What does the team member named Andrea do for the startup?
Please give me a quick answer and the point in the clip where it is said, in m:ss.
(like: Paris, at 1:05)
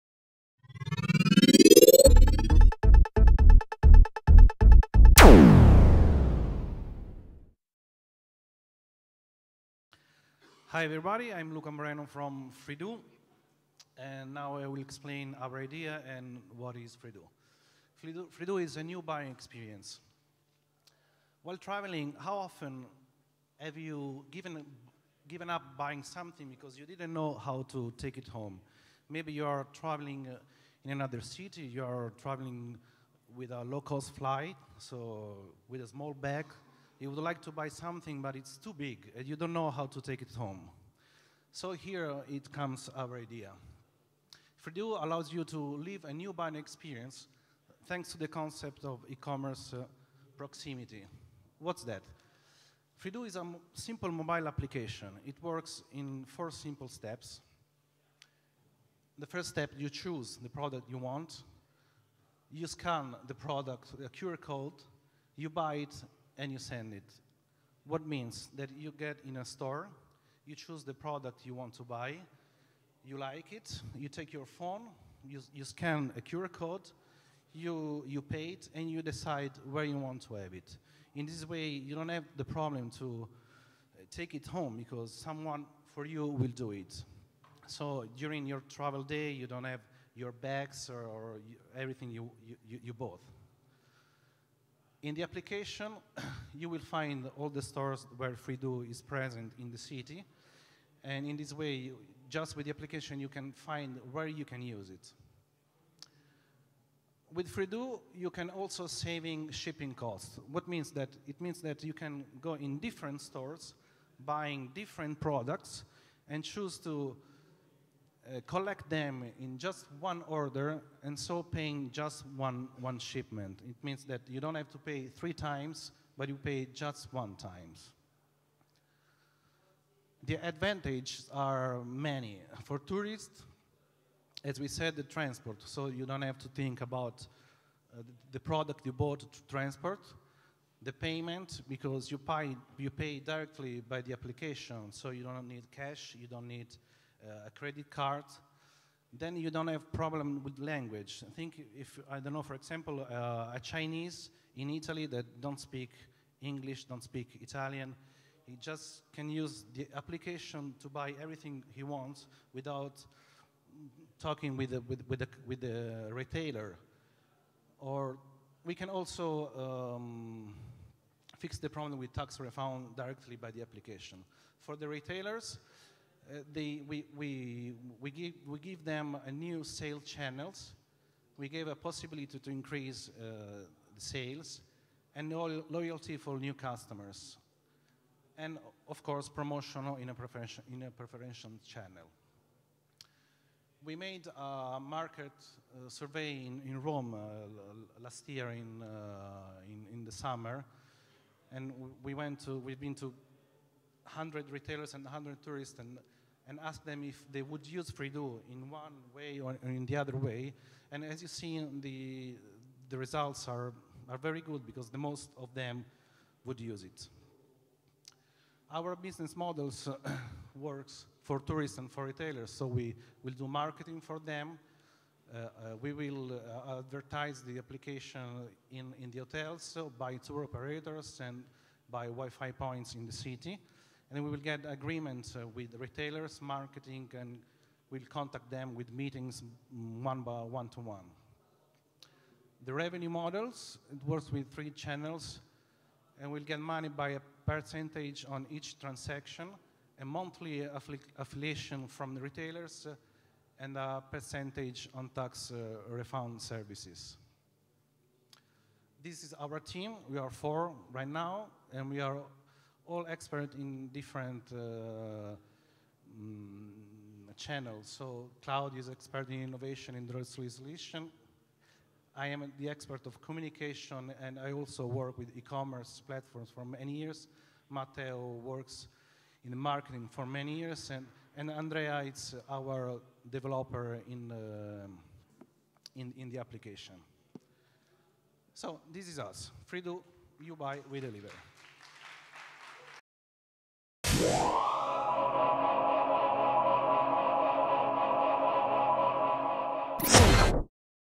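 developer, at 4:43.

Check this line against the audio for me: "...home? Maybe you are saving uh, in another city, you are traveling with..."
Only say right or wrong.
wrong.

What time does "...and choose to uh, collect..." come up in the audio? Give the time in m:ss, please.
1:56.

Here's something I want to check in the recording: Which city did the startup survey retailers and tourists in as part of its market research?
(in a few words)
Rome.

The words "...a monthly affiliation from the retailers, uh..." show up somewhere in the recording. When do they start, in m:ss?
4:09.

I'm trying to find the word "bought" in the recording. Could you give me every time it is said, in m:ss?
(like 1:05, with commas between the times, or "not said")
1:32, 2:18.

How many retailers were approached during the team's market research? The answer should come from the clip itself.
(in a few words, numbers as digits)
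100.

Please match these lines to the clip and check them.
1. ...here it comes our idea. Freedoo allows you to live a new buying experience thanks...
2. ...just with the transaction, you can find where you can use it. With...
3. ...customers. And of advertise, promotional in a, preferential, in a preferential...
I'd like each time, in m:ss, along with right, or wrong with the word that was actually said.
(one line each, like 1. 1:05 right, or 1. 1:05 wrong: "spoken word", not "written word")
1. 0:41 right
2. 1:42 wrong: "application", not "transaction"
3. 3:06 wrong: "course", not "advertise".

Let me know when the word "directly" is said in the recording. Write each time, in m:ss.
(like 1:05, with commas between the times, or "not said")
2:23, 2:52.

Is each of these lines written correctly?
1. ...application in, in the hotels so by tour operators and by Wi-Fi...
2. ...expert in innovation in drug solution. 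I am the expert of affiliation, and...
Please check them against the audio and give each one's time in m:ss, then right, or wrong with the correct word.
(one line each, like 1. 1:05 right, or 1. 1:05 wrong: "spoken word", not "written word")
1. 3:47 right
2. 4:28 wrong: "communication", not "affiliation".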